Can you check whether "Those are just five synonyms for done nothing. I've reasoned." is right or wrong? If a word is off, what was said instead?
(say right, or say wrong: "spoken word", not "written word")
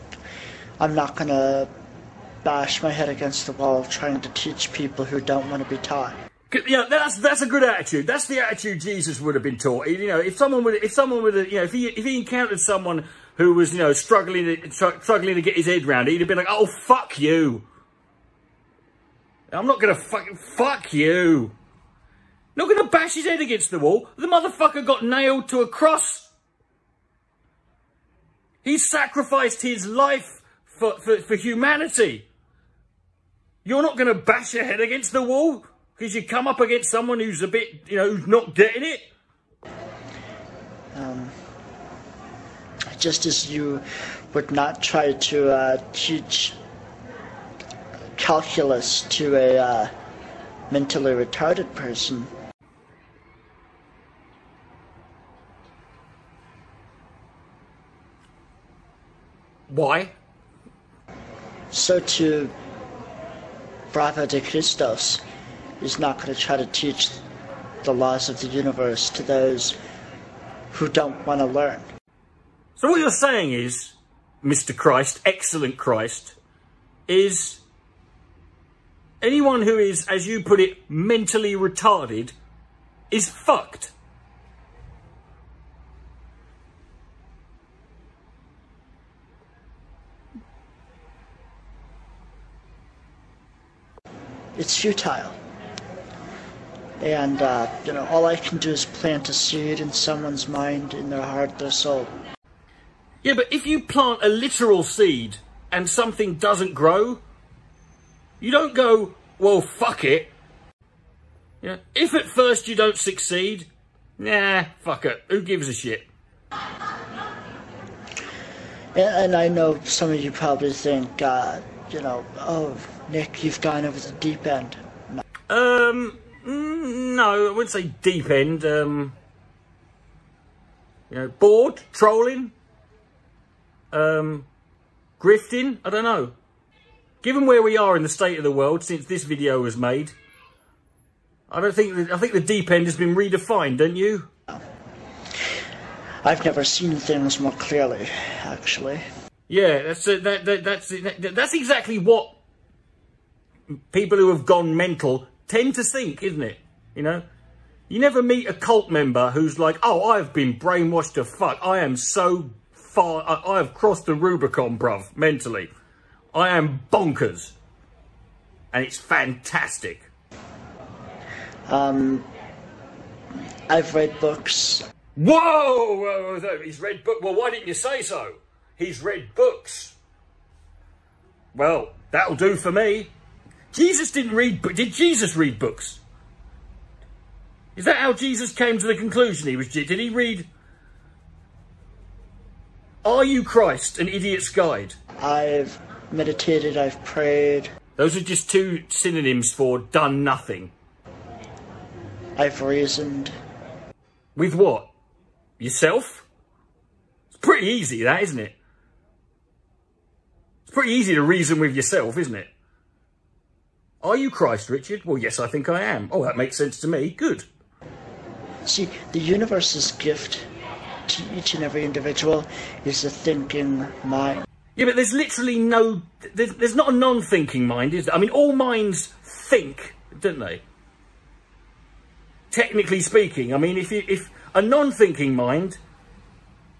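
wrong: "two", not "five".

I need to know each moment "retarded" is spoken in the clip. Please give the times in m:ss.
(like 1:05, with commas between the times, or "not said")
0:51, 1:21.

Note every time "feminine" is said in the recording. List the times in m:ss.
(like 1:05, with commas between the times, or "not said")
not said.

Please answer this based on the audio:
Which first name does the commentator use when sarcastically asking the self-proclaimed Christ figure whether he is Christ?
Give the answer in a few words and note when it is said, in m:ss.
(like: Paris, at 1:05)
Richard, at 3:34.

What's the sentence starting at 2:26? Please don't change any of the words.
I've never seen things more clearly, actually.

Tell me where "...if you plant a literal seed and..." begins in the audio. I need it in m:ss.
1:43.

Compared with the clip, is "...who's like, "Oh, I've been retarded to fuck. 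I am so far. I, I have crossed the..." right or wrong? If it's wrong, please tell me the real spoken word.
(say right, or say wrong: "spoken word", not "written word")
wrong: "brainwashed", not "retarded".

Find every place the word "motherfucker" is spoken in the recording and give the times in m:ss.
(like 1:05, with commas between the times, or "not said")
0:24.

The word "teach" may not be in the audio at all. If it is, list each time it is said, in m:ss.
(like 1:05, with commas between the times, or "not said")
0:04, 0:45, 1:06.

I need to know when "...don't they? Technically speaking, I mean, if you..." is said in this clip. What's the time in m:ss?
3:50.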